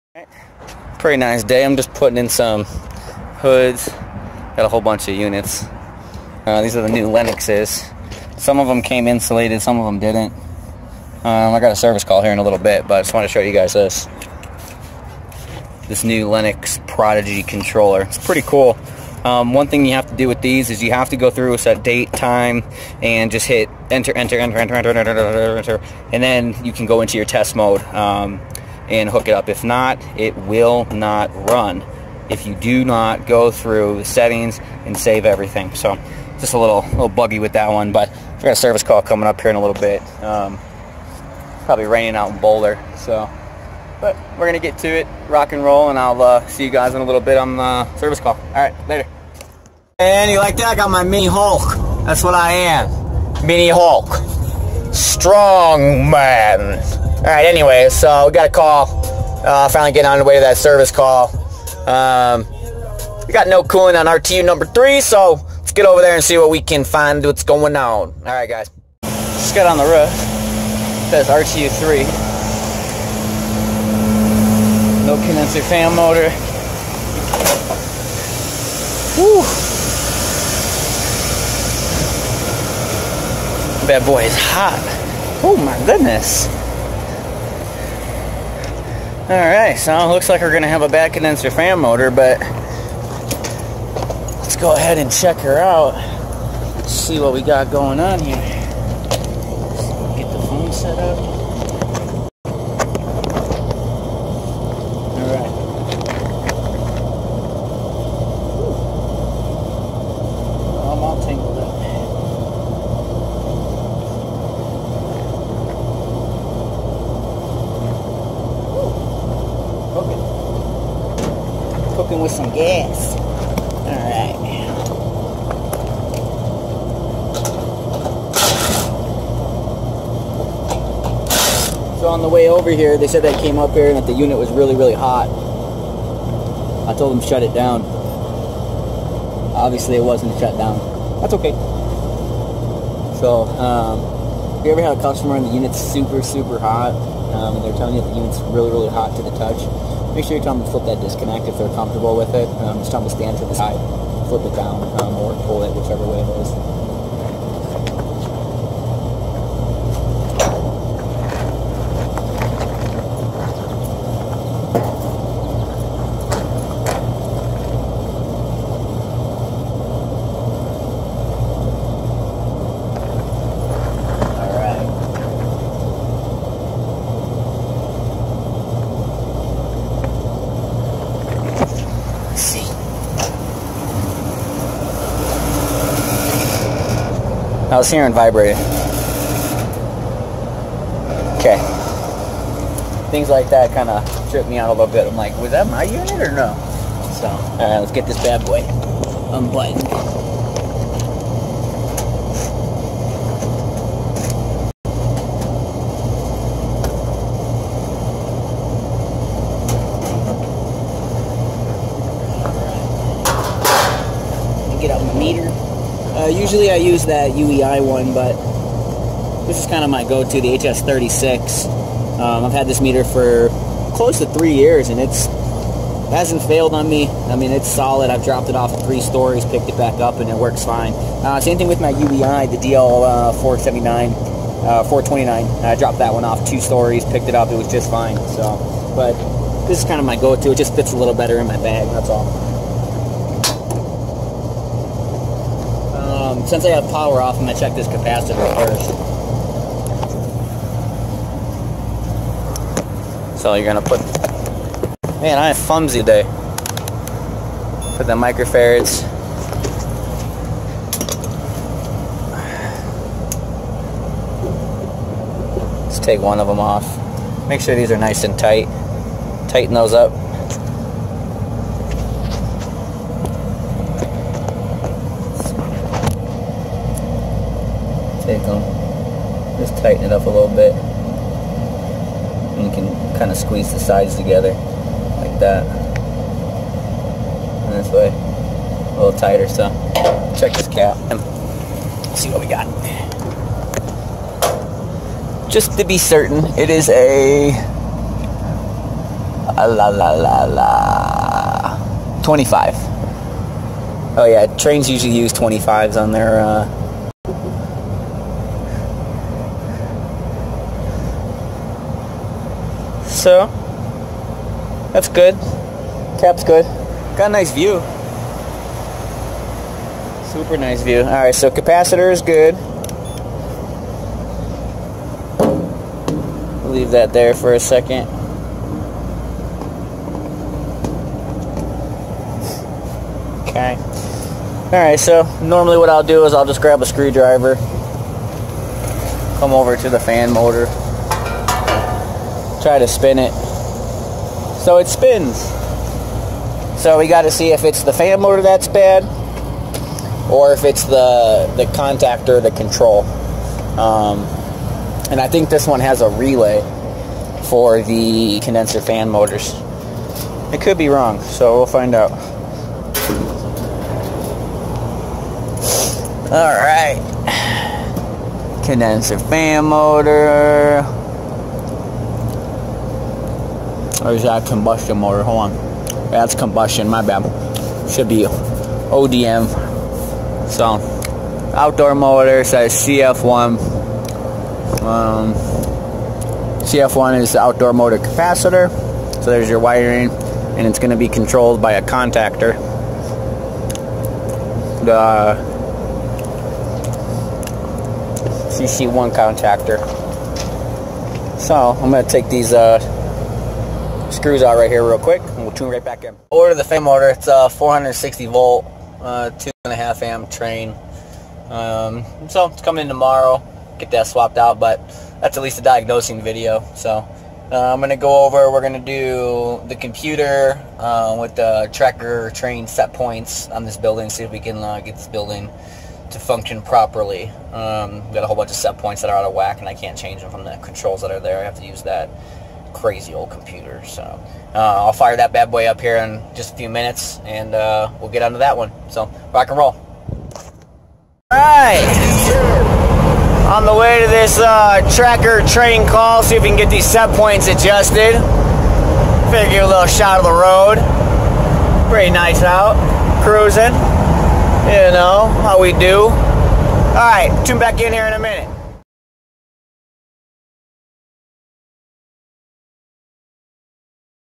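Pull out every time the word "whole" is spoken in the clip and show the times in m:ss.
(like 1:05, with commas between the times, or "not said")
0:04, 7:08.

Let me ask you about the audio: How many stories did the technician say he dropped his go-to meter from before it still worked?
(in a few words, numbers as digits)
3.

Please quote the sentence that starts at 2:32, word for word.
Um, just tell them to stand to the side, flip it down, um, or pull it, whichever way it is.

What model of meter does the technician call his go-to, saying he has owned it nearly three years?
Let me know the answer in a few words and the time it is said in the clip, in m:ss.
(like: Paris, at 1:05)
HS36, at 3:40.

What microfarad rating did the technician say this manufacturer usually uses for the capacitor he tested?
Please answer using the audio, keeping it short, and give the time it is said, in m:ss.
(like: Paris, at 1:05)
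25, at 5:05.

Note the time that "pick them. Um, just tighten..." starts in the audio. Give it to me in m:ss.
4:38.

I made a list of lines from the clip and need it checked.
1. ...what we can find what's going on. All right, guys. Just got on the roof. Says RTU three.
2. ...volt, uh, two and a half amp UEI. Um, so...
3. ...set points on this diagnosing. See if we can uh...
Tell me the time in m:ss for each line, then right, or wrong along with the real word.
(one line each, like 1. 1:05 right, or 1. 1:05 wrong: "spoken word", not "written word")
1. 1:06 right
2. 6:48 wrong: "Trane", not "UEI"
3. 7:02 wrong: "building", not "diagnosing".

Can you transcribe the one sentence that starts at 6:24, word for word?
Um, CF1 is the outdoor motor capacitor.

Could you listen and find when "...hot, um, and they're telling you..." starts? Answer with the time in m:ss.
2:26.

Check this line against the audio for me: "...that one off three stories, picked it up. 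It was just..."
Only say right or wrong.
wrong.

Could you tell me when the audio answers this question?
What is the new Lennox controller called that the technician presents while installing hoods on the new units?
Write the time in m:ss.
0:16.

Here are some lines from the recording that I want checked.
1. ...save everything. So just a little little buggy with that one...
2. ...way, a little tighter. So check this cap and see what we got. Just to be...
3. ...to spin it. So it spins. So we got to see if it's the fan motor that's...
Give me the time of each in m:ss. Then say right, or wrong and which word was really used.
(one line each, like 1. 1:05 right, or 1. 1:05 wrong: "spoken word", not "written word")
1. 0:34 right
2. 4:47 right
3. 5:42 right.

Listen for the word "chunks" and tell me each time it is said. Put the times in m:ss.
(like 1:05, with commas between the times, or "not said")
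not said.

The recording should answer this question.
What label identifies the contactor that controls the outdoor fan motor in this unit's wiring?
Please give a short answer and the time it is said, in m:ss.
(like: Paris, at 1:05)
CC1, at 6:38.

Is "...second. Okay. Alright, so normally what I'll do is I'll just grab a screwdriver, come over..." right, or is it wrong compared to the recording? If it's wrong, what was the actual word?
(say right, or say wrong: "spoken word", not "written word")
right.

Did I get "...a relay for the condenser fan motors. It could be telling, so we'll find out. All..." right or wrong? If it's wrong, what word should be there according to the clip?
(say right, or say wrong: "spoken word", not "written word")
wrong: "wrong", not "telling".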